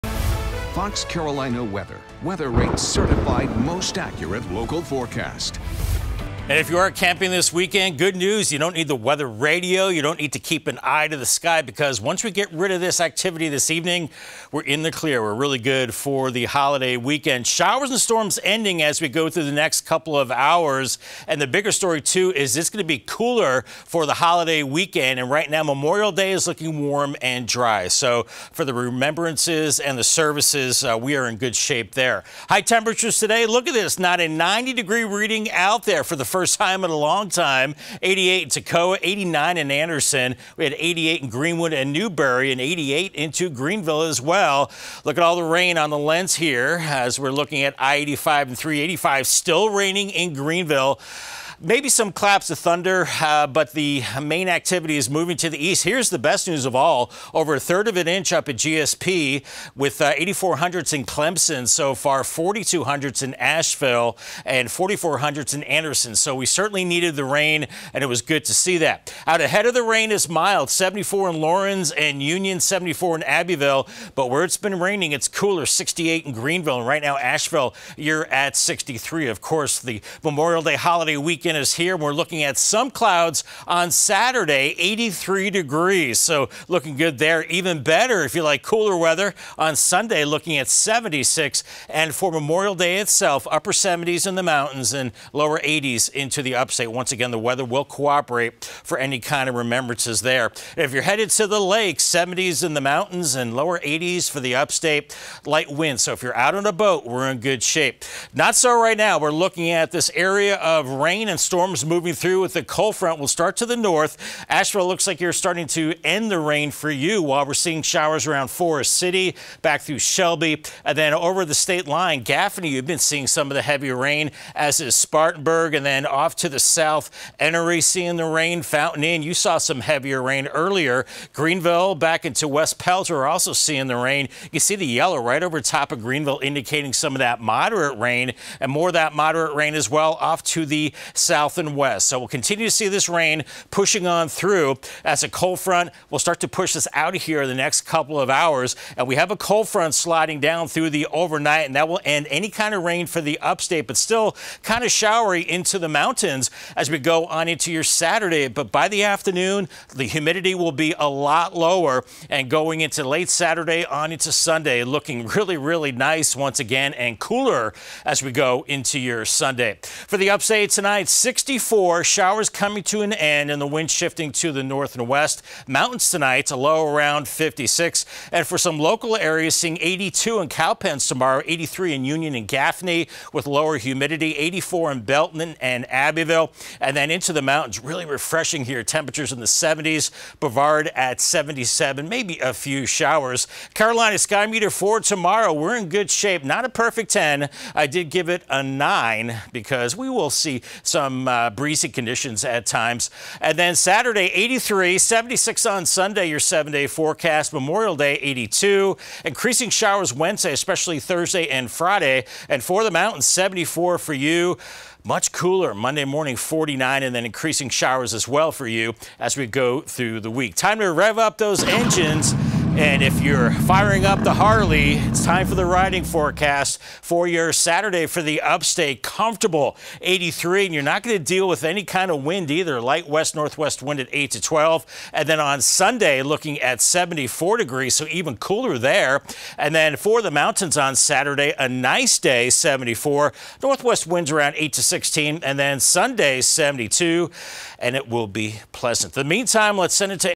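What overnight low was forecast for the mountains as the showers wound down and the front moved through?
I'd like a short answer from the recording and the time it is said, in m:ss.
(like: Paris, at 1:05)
56, at 2:56.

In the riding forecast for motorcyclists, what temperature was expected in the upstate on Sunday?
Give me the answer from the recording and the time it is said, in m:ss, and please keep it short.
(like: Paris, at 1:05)
74 degrees, at 3:56.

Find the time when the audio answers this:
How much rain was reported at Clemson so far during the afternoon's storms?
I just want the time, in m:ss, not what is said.
1:00.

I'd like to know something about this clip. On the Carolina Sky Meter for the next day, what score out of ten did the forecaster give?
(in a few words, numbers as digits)
9.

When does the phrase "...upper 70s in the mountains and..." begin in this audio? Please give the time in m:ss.
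1:33.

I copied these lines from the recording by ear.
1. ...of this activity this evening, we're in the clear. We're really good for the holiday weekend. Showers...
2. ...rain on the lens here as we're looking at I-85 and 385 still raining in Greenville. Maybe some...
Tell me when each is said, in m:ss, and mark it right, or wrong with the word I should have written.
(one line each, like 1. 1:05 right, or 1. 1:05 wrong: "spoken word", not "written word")
1. 0:12 right
2. 0:45 right.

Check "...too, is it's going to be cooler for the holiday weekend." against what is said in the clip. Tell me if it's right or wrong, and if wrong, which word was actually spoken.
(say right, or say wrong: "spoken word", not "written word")
right.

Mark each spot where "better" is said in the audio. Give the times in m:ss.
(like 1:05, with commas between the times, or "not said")
1:27.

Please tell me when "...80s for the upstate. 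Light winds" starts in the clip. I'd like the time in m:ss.
1:43.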